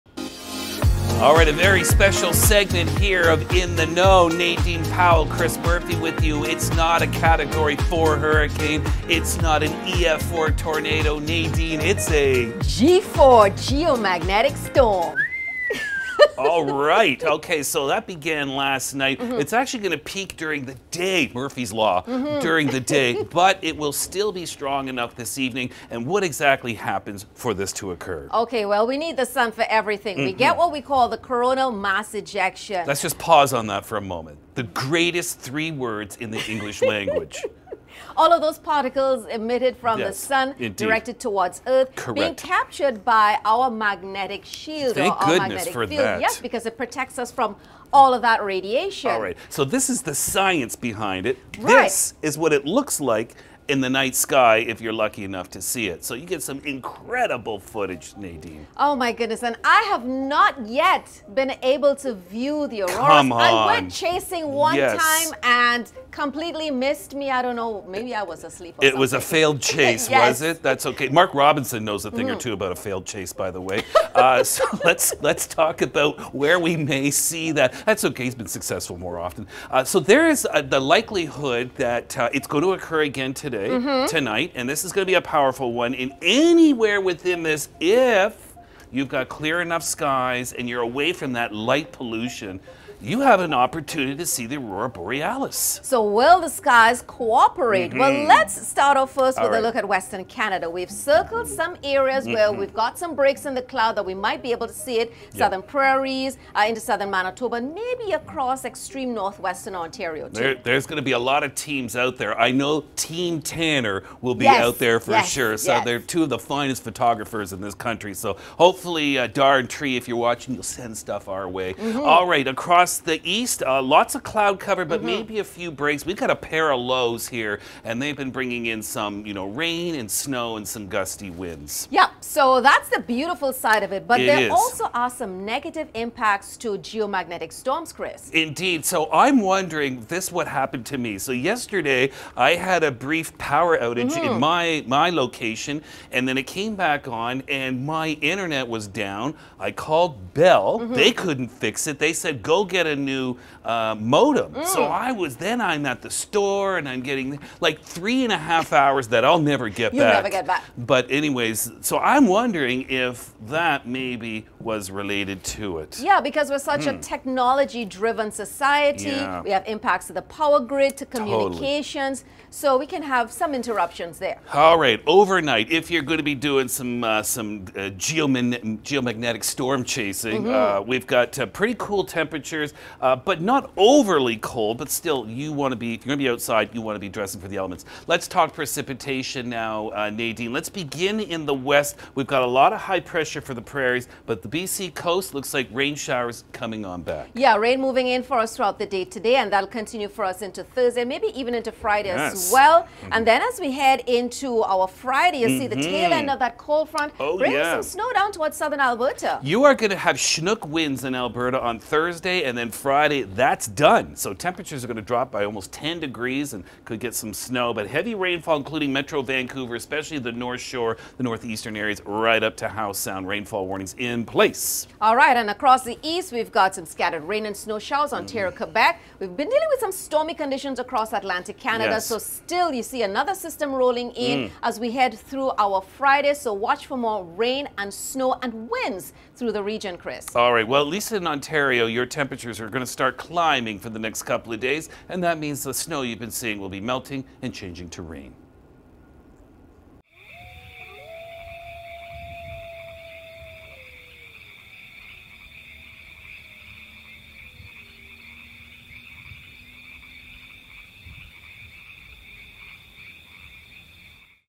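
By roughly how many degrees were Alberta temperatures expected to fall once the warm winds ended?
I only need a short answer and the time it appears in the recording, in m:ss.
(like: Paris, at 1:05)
almost 10 degrees, at 3:35.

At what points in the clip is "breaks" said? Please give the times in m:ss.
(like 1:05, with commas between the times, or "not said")
1:43, 2:05.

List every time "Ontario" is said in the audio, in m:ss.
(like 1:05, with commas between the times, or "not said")
1:49, 3:48, 4:01.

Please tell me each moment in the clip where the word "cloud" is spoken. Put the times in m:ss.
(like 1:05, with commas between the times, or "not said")
1:43, 2:04.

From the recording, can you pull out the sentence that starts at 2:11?
Yeah, so that's the beautiful side of it, but it there is.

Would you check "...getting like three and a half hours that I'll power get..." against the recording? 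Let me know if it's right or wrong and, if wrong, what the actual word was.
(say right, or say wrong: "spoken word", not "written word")
wrong: "never", not "power".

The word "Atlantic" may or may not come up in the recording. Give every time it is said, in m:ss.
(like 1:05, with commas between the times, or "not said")
3:51.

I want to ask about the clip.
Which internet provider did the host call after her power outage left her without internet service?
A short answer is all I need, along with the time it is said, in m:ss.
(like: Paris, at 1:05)
Bell, at 2:30.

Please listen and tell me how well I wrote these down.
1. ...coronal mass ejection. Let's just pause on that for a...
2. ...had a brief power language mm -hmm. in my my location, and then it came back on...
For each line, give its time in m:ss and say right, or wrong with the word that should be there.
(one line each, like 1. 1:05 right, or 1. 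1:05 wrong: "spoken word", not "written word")
1. 0:31 right
2. 2:22 wrong: "outage", not "language".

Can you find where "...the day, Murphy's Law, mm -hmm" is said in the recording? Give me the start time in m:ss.
0:20.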